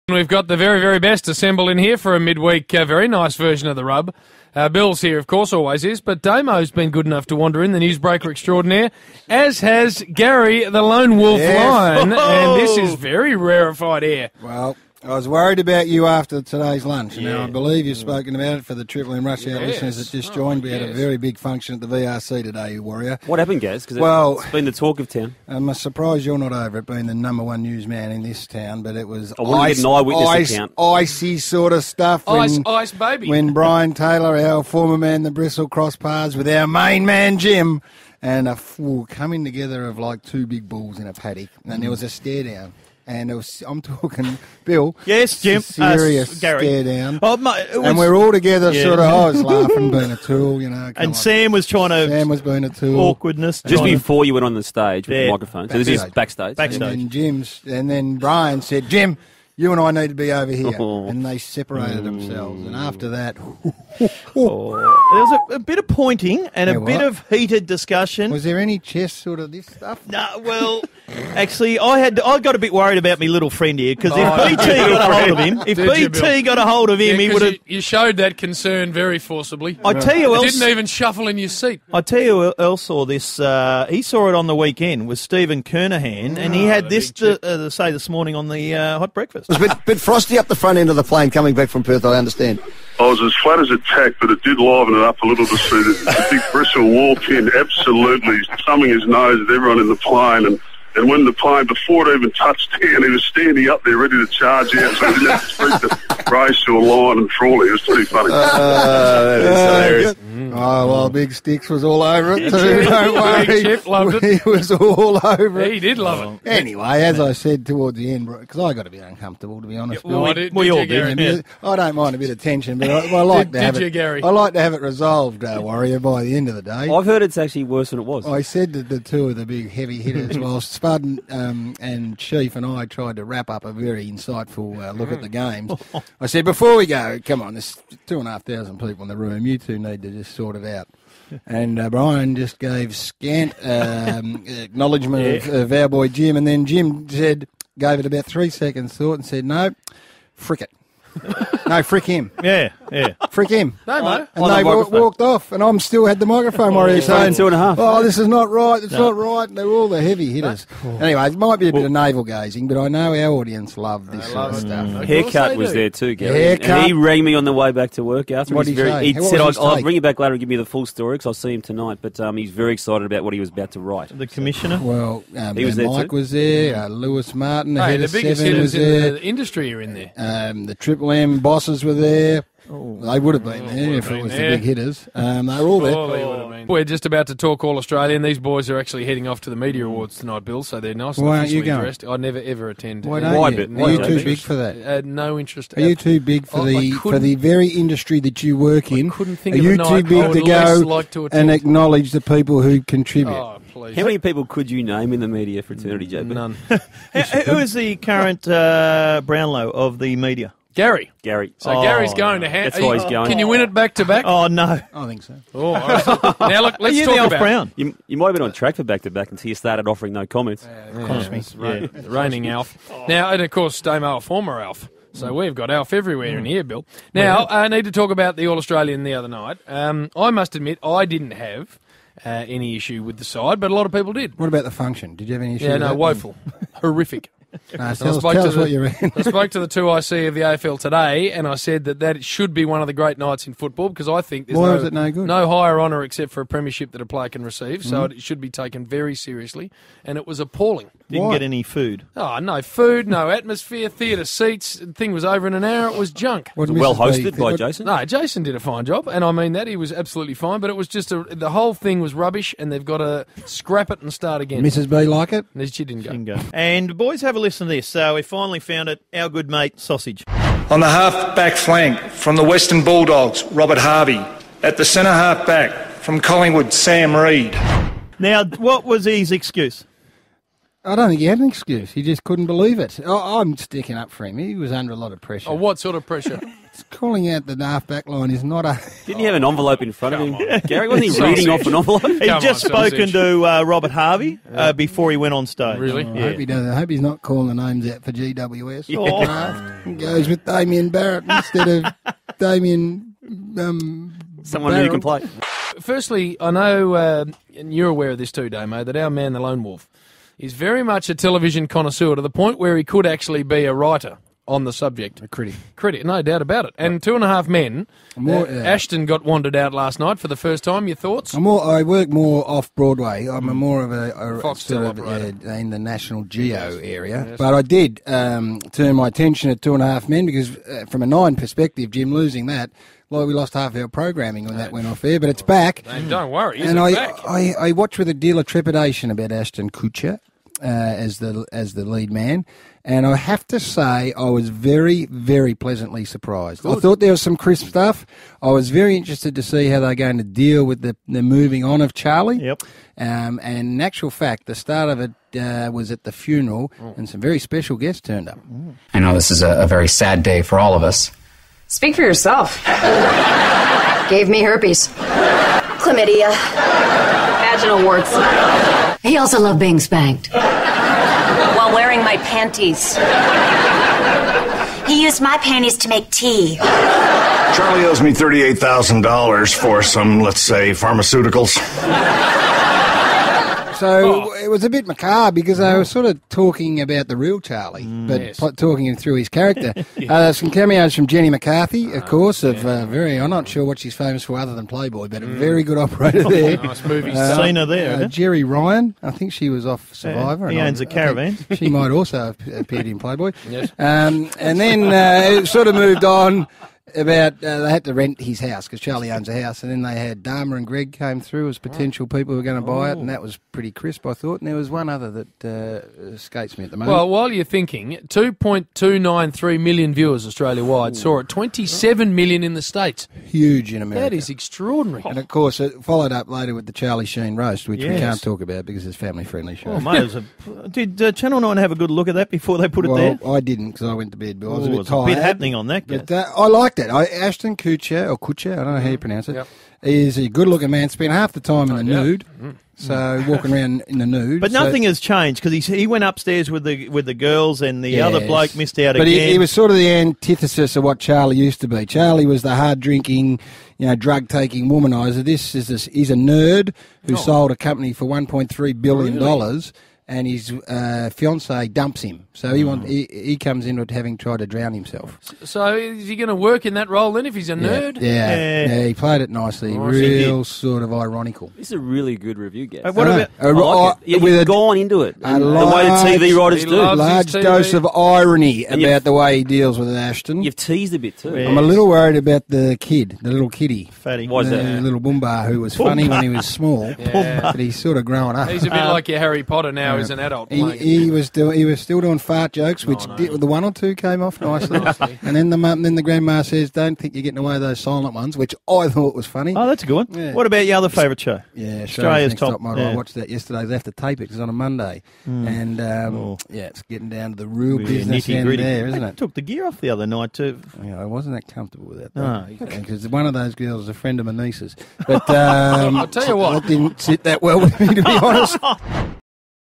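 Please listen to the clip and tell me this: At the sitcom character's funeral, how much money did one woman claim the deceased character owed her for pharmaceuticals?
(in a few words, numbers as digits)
$38,000.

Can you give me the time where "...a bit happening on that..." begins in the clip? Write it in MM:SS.
07:15.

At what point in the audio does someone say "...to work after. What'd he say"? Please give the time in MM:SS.
02:47.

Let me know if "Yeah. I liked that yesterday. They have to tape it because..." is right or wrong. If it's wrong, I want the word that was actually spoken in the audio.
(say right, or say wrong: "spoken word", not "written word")
wrong: "watched", not "liked".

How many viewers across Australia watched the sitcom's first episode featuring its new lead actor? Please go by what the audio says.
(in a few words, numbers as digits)
2.293 million.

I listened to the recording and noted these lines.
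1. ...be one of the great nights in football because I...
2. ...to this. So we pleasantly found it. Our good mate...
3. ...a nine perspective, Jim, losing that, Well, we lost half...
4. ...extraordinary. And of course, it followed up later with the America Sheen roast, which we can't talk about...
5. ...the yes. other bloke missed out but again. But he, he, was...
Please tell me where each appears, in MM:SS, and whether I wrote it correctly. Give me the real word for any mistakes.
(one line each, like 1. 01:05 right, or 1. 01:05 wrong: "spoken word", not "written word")
1. 04:02 right
2. 04:27 wrong: "finally", not "pleasantly"
3. 05:31 right
4. 07:04 wrong: "Charlie", not "America"
5. 07:27 right.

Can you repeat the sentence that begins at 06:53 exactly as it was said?
that was pretty crisp, I thought.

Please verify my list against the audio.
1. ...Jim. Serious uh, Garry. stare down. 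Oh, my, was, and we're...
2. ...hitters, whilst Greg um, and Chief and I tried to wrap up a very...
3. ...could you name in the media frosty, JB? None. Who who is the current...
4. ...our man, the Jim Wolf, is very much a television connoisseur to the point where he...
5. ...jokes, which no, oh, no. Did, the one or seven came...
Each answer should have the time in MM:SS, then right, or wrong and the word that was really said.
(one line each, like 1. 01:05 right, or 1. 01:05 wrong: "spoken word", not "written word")
1. 00:45 right
2. 02:10 wrong: "Spud", not "Greg"
3. 03:24 wrong: "fraternity", not "frosty"
4. 05:08 wrong: "Lone", not "Jim"
5. 08:12 wrong: "two", not "seven".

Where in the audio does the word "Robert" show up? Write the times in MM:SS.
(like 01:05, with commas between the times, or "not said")
04:33, 04:53.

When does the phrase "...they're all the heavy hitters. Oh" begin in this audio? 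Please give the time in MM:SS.
02:39.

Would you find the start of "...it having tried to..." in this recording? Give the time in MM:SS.
07:43.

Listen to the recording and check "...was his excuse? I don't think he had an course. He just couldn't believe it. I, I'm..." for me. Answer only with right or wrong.
wrong.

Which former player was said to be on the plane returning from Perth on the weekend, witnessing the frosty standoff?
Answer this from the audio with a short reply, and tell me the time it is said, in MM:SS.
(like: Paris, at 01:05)
Stephen Kernahan, at 01:25.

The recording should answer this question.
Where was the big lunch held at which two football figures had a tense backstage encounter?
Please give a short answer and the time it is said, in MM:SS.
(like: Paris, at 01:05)
VRC, at 00:21.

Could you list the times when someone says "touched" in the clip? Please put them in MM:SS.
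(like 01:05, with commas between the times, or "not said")
01:42.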